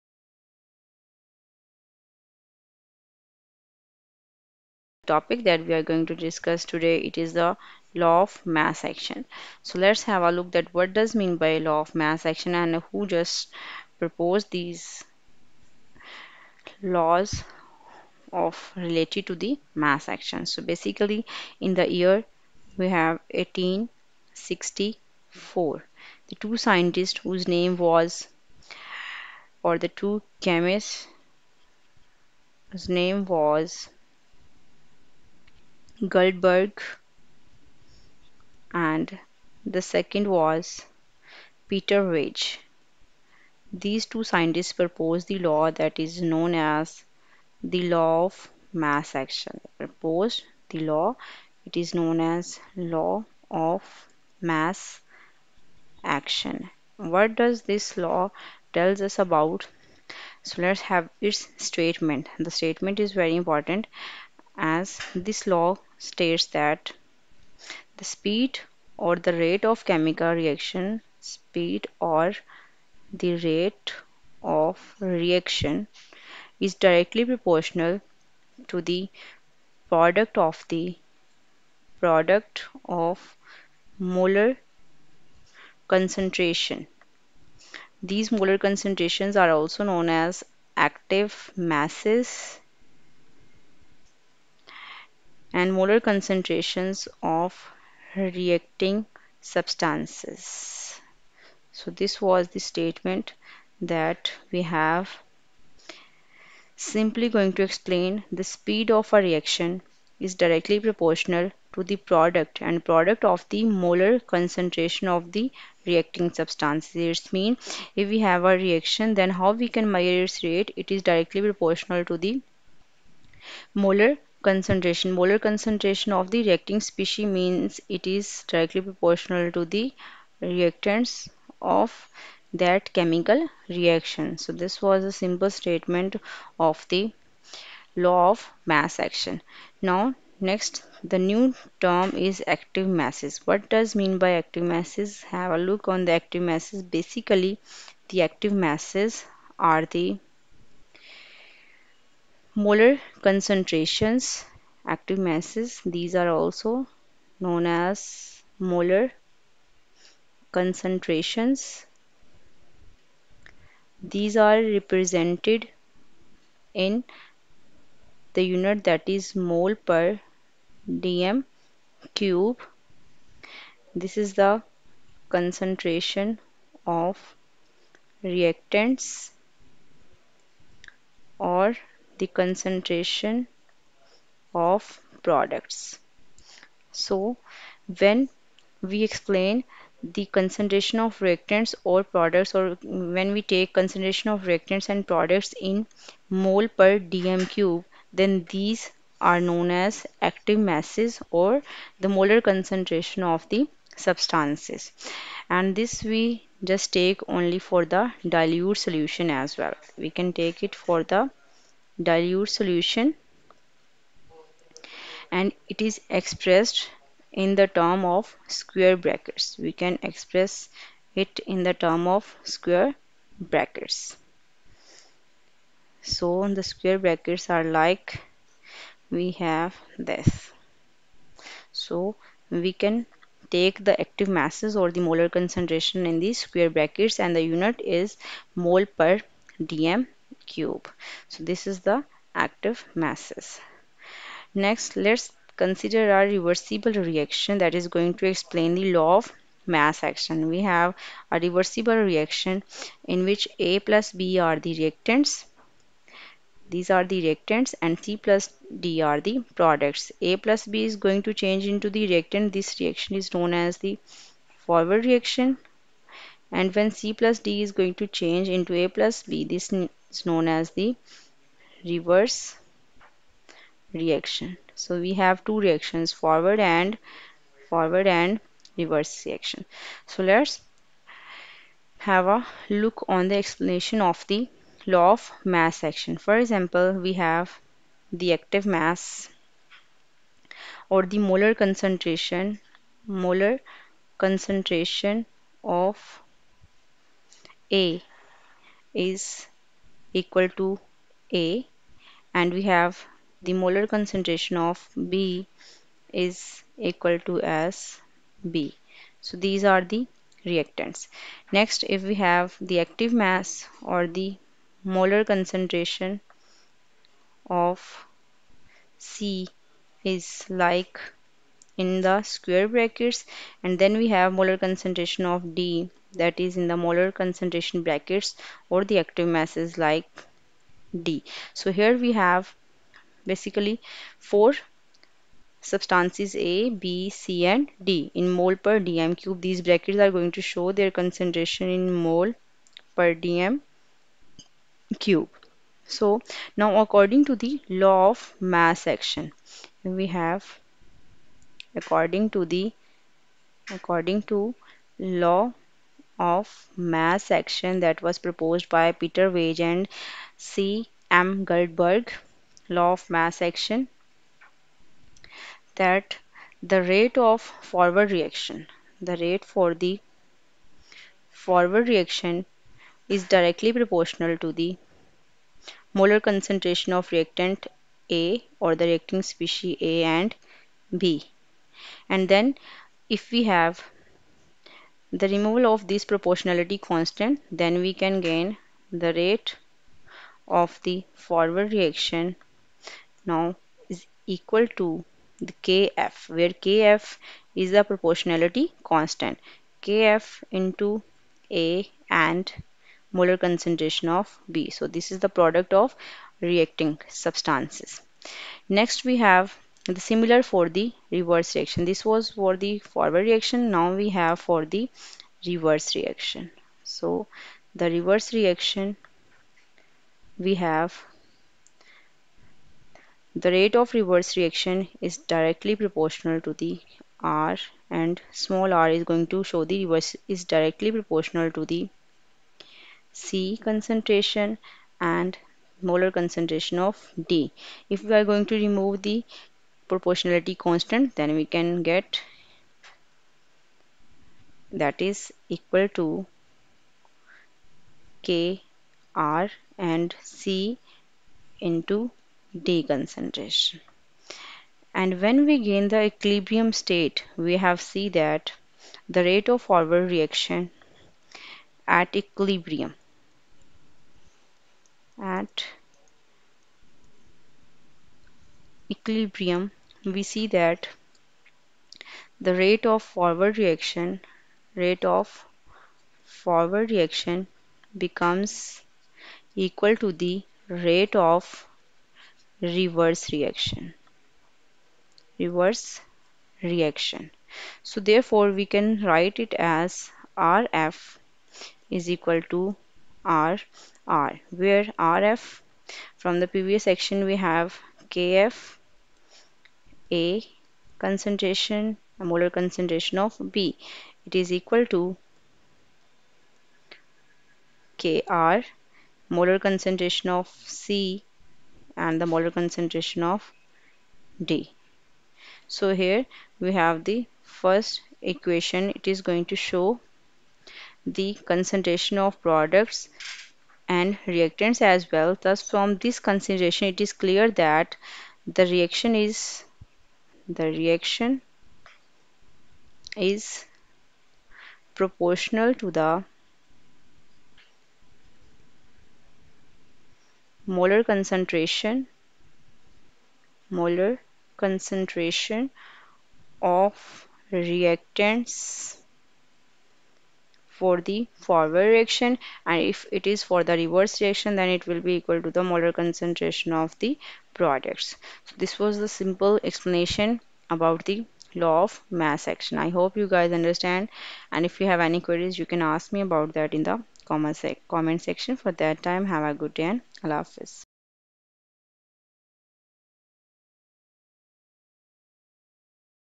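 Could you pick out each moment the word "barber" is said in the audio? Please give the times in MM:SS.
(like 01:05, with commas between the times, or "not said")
not said.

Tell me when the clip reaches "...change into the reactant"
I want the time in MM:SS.
04:21.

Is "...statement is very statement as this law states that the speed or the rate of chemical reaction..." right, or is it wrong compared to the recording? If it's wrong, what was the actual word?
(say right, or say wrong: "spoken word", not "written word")
wrong: "important", not "statement".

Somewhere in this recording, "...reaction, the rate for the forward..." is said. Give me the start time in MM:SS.
06:08.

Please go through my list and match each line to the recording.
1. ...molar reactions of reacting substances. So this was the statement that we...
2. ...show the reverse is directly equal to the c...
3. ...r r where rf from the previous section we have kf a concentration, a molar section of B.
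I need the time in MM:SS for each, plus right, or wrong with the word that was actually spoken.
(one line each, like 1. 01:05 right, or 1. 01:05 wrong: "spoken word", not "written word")
1. 01:35 wrong: "concentrations", not "reactions"
2. 07:09 wrong: "proportional", not "equal"
3. 08:13 wrong: "concentration", not "section".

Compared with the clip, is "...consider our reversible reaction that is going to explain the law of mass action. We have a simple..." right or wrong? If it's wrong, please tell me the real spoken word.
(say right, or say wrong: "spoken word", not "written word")
wrong: "reversible", not "simple".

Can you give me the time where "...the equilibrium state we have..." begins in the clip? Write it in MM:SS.
07:35.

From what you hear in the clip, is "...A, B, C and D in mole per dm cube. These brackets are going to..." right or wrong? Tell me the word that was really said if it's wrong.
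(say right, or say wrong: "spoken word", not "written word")
right.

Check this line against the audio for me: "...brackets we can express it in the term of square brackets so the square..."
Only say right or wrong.
right.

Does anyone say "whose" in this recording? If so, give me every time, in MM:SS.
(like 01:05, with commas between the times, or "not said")
00:27, 00:32.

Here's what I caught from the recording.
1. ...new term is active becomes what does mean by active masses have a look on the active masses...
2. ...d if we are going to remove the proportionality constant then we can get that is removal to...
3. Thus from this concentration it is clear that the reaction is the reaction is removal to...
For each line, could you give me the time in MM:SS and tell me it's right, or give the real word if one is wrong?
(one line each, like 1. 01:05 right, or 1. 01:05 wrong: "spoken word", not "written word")
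1. 02:21 wrong: "masses", not "becomes"
2. 07:17 wrong: "equal", not "removal"
3. 08:45 wrong: "proportional", not "removal".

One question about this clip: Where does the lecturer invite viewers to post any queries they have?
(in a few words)
Comment section.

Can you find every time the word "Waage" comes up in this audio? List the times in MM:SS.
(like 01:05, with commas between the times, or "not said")
00:42, 05:59.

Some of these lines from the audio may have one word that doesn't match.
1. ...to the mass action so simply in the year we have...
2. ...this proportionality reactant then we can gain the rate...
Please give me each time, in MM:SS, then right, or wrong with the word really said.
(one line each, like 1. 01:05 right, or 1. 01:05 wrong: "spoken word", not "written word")
1. 00:19 wrong: "basically", not "simply"
2. 06:25 wrong: "constant", not "reactant".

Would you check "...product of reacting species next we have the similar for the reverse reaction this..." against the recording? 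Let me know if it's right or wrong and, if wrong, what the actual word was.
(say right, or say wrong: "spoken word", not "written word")
wrong: "substances", not "species".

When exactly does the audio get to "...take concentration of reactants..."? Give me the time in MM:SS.
03:13.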